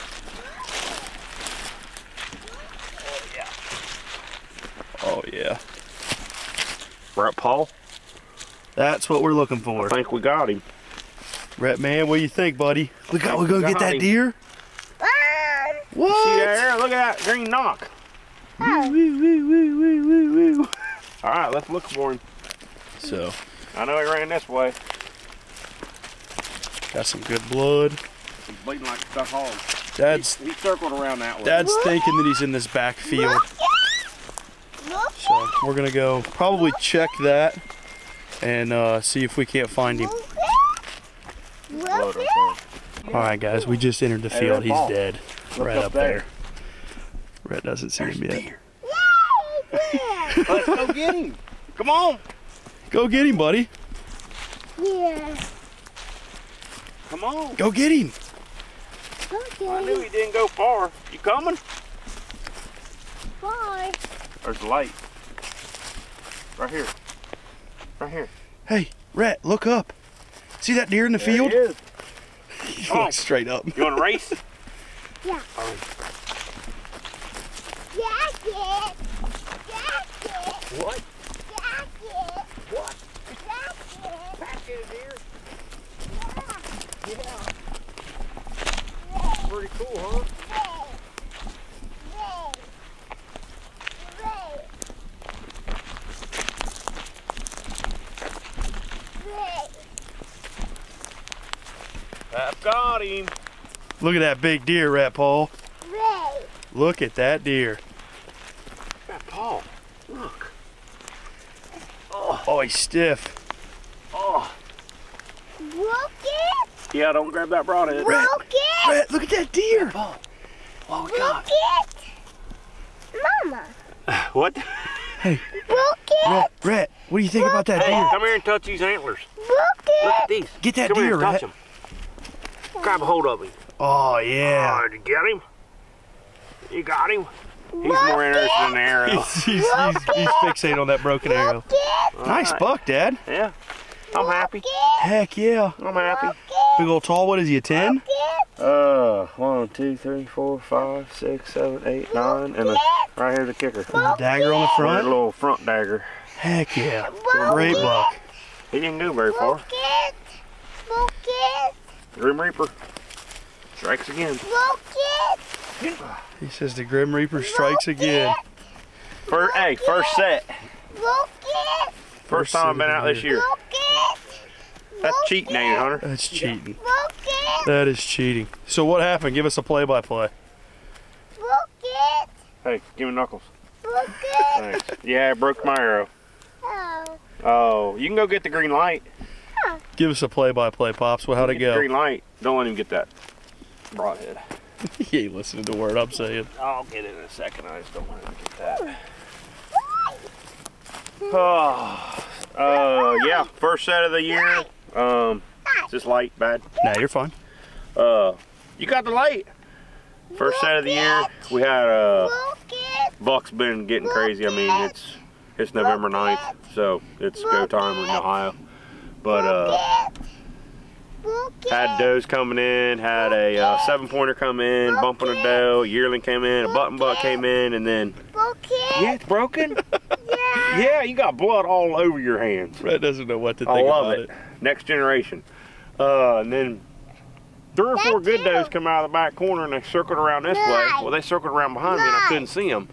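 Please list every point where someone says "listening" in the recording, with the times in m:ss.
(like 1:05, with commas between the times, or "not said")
3:15.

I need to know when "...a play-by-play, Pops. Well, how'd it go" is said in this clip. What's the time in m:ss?
3:10.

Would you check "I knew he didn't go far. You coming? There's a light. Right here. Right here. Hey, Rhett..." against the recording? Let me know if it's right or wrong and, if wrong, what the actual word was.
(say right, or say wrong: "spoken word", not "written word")
right.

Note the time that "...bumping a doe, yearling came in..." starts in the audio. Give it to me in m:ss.
3:44.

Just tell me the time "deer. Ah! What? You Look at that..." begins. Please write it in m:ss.
0:14.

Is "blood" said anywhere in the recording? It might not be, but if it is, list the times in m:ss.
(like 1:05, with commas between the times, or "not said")
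0:27, 3:51.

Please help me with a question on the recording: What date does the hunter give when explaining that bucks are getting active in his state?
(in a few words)
November 9th.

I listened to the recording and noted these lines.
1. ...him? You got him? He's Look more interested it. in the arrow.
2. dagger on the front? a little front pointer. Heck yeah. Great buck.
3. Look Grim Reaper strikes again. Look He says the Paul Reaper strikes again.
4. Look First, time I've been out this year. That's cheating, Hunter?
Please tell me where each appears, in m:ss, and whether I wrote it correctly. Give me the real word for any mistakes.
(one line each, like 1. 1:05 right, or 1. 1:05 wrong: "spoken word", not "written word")
1. 2:15 right
2. 2:34 wrong: "dagger", not "pointer"
3. 2:40 wrong: "Grim", not "Paul"
4. 2:50 right.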